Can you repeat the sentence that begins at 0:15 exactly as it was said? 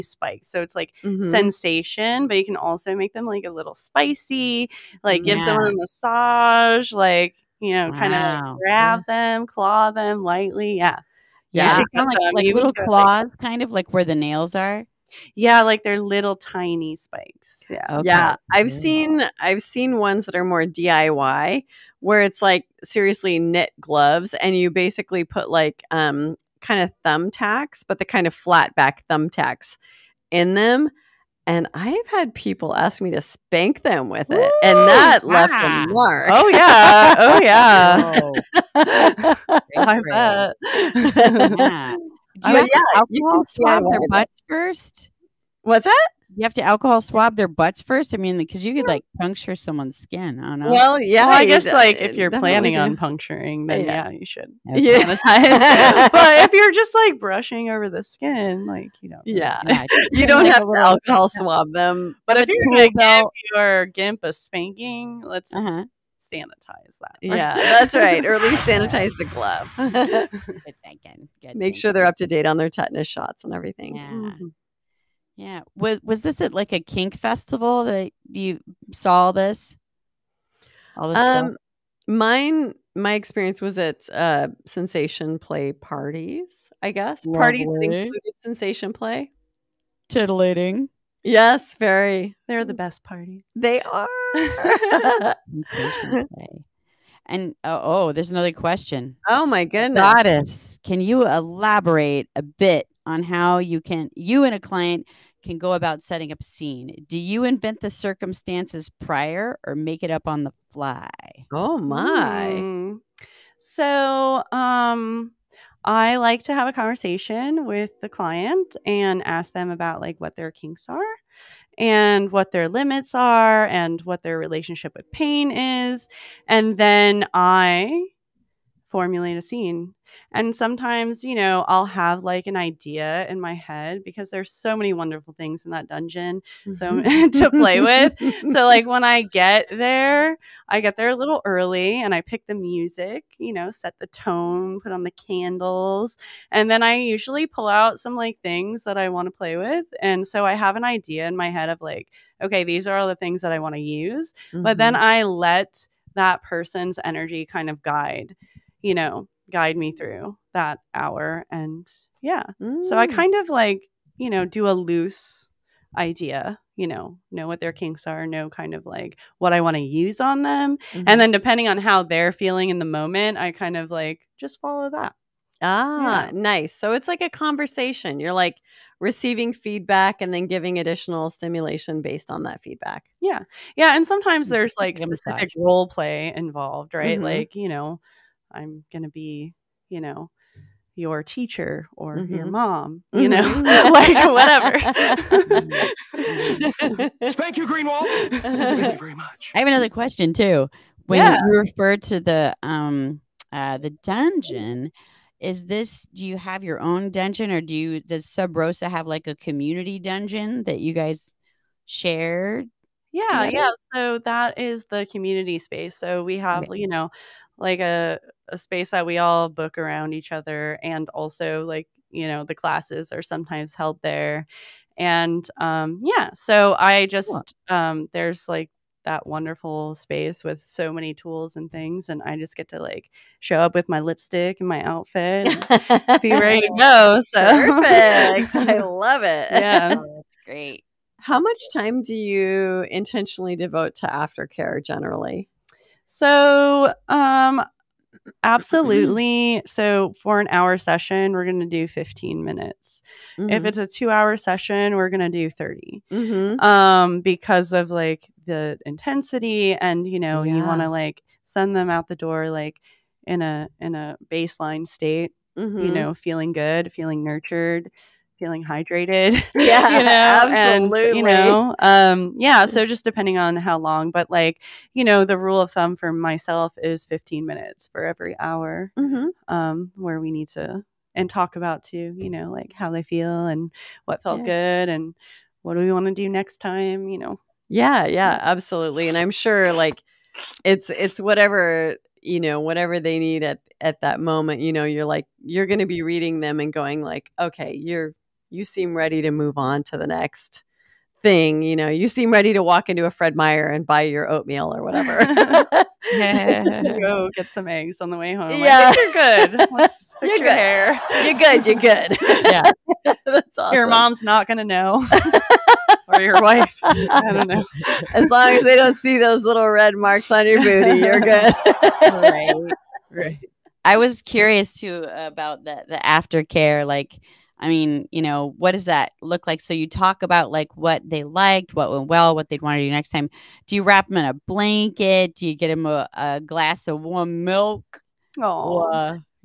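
Yeah, like they're little tiny spikes.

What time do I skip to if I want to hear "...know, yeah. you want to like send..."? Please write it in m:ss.
4:20.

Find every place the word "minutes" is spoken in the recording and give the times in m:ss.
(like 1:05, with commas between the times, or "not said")
4:12, 4:37.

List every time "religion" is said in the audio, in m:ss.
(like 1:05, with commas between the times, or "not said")
not said.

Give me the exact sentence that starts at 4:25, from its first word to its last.
you know, feeling good, feeling nurtured feeling hydrated.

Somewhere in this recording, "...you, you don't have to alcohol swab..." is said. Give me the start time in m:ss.
1:00.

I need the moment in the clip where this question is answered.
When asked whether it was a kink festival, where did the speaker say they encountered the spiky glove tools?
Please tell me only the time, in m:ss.
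1:24.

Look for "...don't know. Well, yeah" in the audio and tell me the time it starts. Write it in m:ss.
0:50.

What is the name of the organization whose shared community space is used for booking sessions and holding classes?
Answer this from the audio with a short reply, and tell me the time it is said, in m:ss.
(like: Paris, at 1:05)
Sub Rosa, at 3:28.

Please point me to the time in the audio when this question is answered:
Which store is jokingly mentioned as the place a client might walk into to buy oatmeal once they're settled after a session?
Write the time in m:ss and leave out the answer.
5:03.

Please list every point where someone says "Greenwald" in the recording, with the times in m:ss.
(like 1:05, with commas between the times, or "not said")
3:17.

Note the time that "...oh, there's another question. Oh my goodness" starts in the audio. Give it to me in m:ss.
1:37.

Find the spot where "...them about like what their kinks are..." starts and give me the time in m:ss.
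1:59.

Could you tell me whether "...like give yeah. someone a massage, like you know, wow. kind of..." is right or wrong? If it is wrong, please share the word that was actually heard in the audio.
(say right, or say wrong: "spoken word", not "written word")
right.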